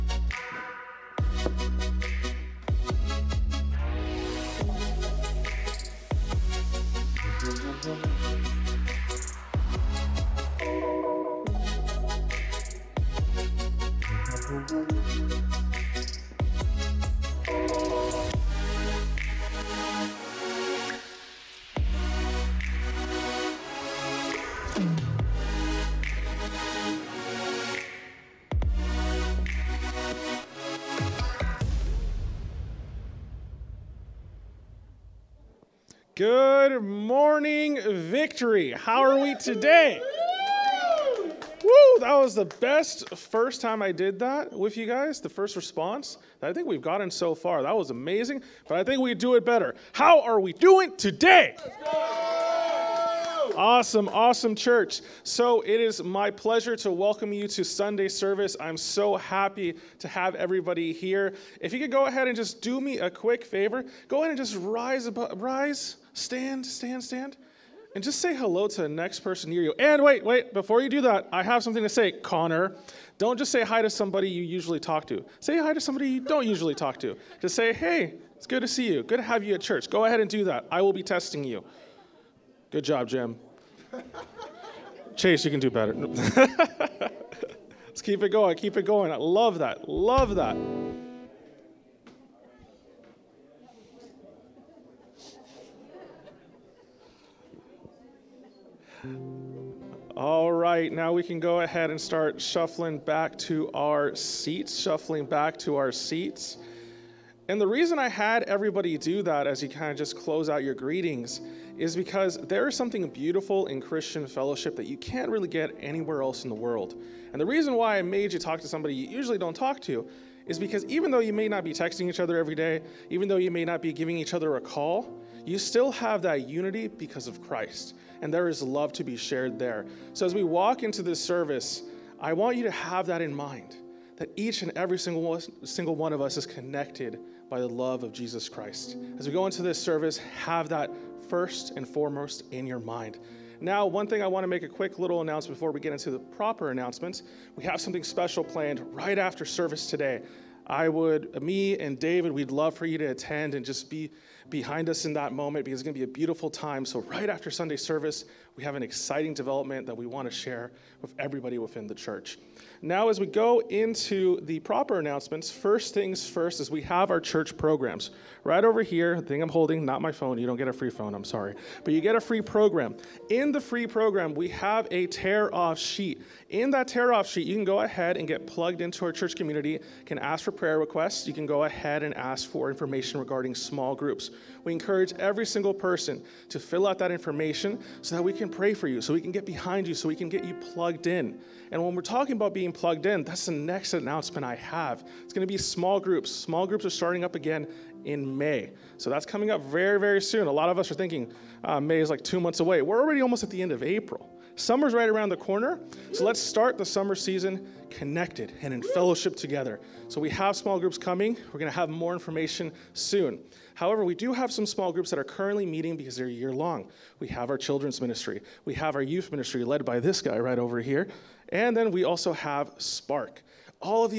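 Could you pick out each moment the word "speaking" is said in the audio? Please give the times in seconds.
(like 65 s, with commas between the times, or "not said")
not said.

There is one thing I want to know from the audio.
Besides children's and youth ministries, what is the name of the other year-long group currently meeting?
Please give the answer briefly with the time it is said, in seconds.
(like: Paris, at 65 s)
Spark, at 222 s.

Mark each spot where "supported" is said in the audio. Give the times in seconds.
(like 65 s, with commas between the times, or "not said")
not said.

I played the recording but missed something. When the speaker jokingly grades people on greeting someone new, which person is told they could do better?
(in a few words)
Chase.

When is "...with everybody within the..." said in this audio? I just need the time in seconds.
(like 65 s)
161 s.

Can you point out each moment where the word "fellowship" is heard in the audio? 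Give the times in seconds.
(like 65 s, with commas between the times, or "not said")
114 s, 208 s.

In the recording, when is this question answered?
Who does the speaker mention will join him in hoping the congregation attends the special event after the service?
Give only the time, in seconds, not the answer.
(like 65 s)
151 s.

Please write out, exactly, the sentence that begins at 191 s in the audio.
And when we're talking about being plugged in, that's the next announcement I have.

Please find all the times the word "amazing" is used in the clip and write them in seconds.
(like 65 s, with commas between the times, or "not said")
47 s.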